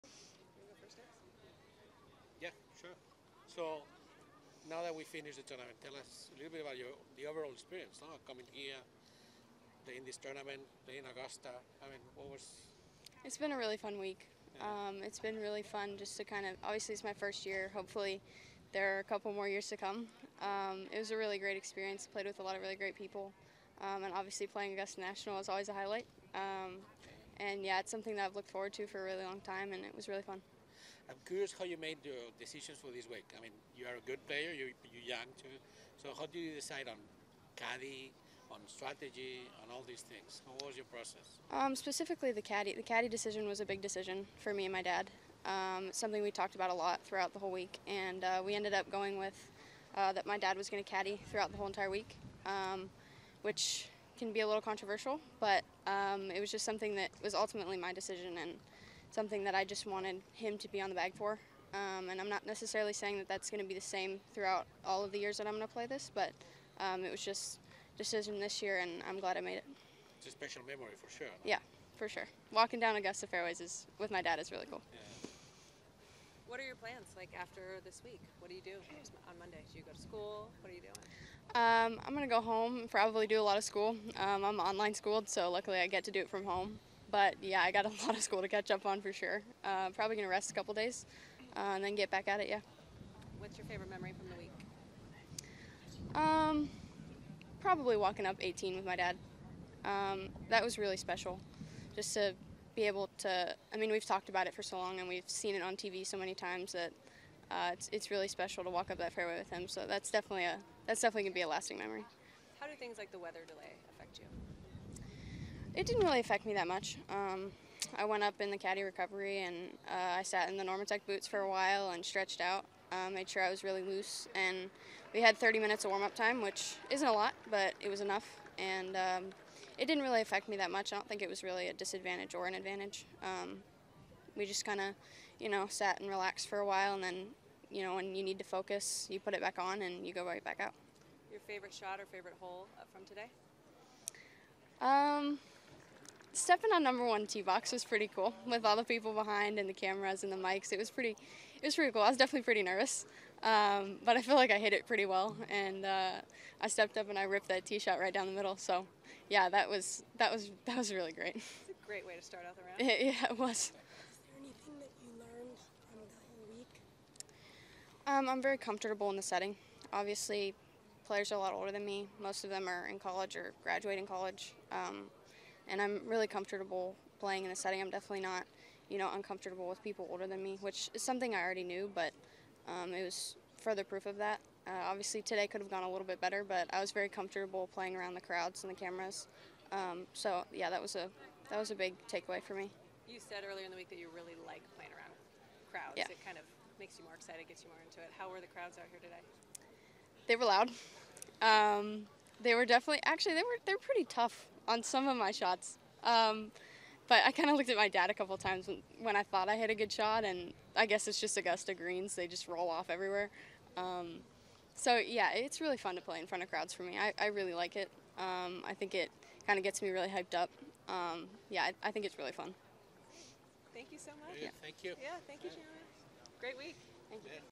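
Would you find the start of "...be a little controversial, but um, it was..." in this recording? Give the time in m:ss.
0:54.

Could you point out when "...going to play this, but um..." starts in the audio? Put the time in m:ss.
1:05.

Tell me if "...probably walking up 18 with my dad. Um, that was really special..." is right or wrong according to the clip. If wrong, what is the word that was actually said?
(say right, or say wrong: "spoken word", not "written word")
right.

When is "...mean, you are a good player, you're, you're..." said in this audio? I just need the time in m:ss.
0:33.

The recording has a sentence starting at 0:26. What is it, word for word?
Um, and yeah, it's something that I've looked forward to for a really long time, and it was really fun.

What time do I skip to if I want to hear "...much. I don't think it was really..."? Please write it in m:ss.
2:10.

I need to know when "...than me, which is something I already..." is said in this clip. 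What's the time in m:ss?
3:00.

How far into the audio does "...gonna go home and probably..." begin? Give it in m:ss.
1:22.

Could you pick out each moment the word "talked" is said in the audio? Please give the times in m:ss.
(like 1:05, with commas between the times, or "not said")
0:46, 1:44.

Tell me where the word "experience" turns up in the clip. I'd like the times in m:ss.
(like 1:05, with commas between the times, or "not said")
0:07, 0:21.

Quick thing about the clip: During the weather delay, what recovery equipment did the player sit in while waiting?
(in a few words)
Normatec boots.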